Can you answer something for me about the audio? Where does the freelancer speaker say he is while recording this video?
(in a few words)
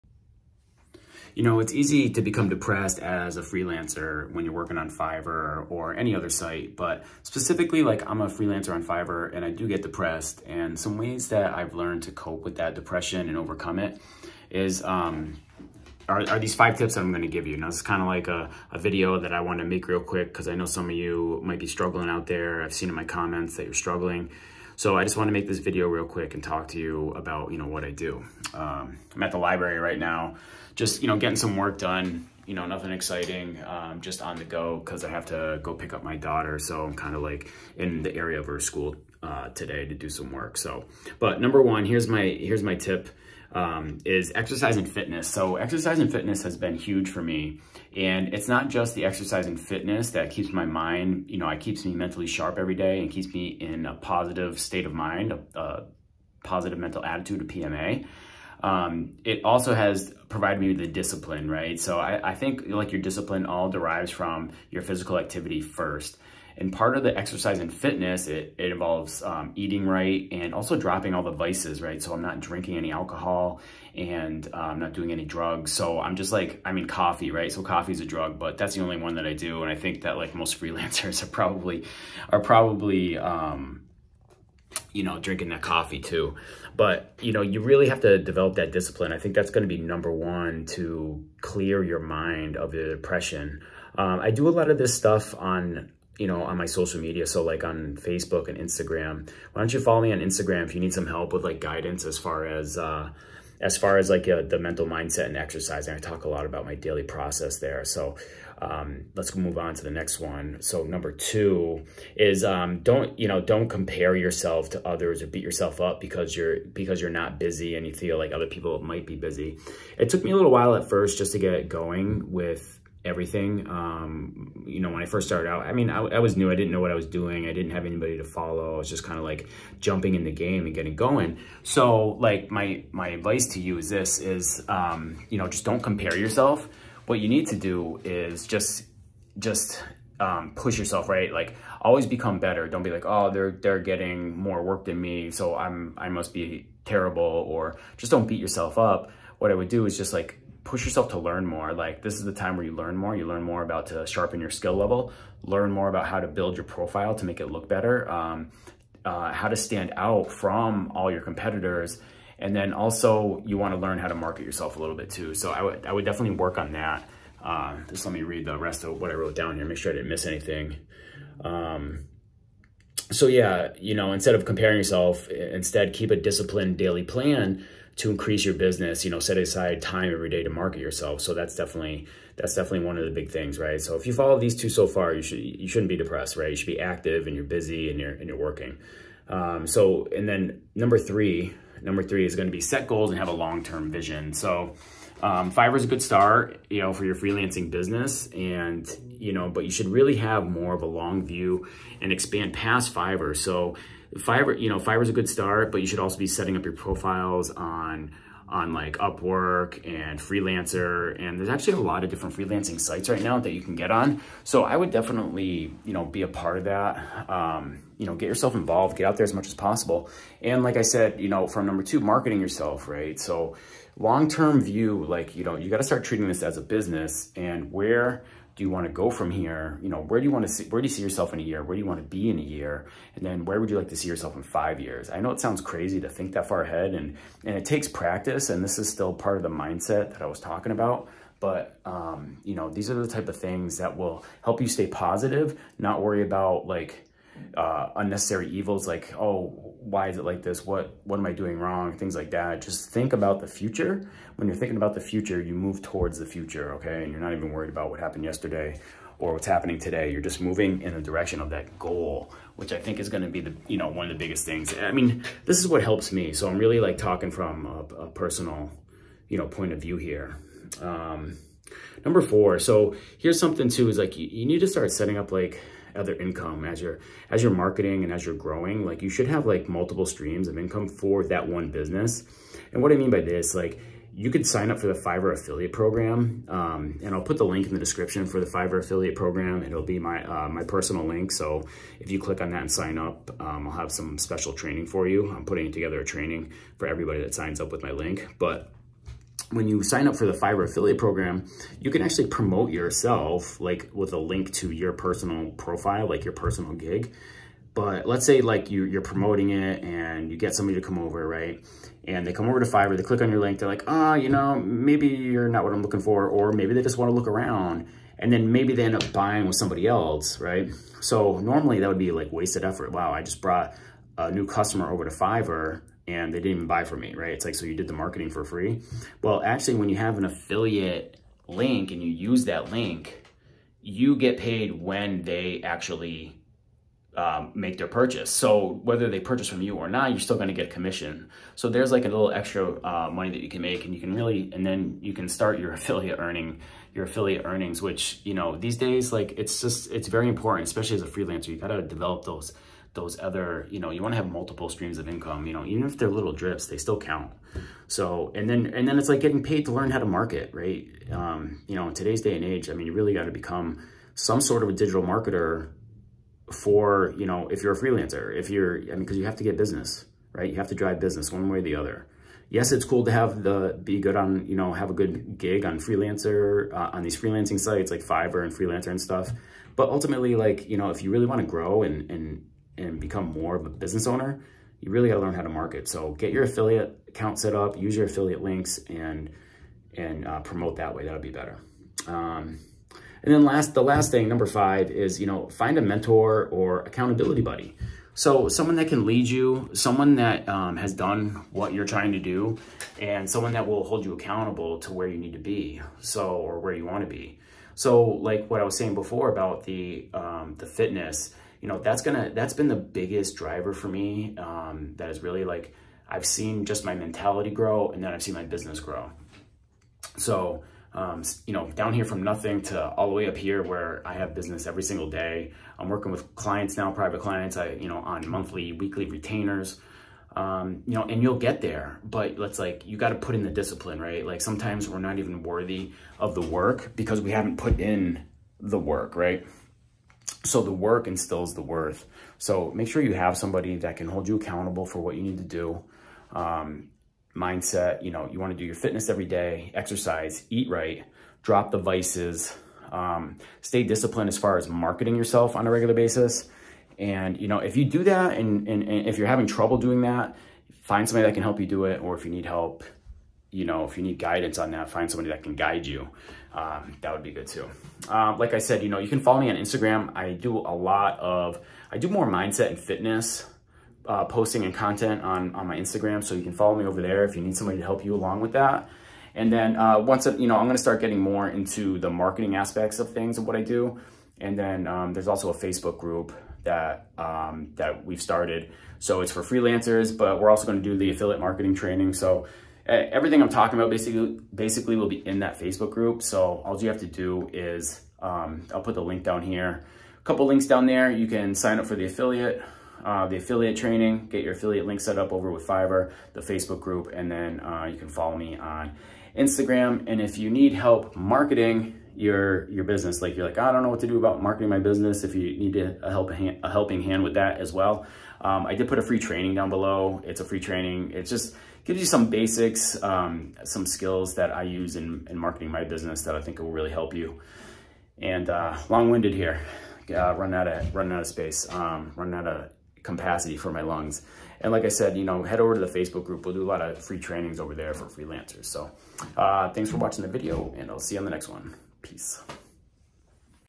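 the library.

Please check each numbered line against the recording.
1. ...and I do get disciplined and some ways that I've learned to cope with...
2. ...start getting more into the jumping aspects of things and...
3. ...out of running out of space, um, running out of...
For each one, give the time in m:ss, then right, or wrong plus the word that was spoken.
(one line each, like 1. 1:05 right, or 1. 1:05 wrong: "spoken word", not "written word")
1. 0:09 wrong: "depressed", not "disciplined"
2. 8:00 wrong: "marketing", not "jumping"
3. 8:50 right.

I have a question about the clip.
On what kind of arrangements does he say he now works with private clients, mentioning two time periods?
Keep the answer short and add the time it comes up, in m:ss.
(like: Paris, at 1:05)
monthly, weekly retainers, at 7:08.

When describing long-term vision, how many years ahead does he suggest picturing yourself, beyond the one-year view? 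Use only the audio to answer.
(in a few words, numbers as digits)
5 years.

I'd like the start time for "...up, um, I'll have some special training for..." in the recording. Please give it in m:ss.
4:52.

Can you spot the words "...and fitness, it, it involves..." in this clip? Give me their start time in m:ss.
1:07.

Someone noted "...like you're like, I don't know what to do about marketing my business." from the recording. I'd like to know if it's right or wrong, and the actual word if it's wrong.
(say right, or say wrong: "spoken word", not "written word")
right.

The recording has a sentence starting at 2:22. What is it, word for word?
Don't be like, oh, they're, they're getting more work than me.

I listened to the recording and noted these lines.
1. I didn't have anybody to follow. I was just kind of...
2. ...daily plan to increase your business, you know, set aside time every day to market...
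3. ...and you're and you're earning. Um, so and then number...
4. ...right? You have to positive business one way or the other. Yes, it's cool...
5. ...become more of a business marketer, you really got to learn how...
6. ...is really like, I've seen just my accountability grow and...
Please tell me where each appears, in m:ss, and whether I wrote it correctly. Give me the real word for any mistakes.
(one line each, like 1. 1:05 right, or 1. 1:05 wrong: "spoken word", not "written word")
1. 2:07 right
2. 2:56 right
3. 3:07 wrong: "working", not "earning"
4. 6:10 wrong: "drive", not "positive"
5. 6:22 wrong: "owner", not "marketer"
6. 6:55 wrong: "mentality", not "accountability".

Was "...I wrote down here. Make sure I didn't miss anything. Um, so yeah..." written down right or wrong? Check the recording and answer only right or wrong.
right.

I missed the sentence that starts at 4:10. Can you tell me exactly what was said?
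What, what am I doing wrong?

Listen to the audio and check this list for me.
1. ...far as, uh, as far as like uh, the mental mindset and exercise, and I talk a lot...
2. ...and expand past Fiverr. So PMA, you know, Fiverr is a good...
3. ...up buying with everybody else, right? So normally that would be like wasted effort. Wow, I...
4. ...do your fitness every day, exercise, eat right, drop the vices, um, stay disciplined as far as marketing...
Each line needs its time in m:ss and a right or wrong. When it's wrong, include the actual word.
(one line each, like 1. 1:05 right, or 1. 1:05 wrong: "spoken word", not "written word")
1. 1:42 right
2. 3:22 wrong: "Fiverr", not "PMA"
3. 5:18 wrong: "somebody", not "everybody"
4. 7:28 right.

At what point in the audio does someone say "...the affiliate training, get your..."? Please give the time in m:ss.
8:23.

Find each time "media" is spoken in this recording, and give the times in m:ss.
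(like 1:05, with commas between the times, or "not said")
1:37.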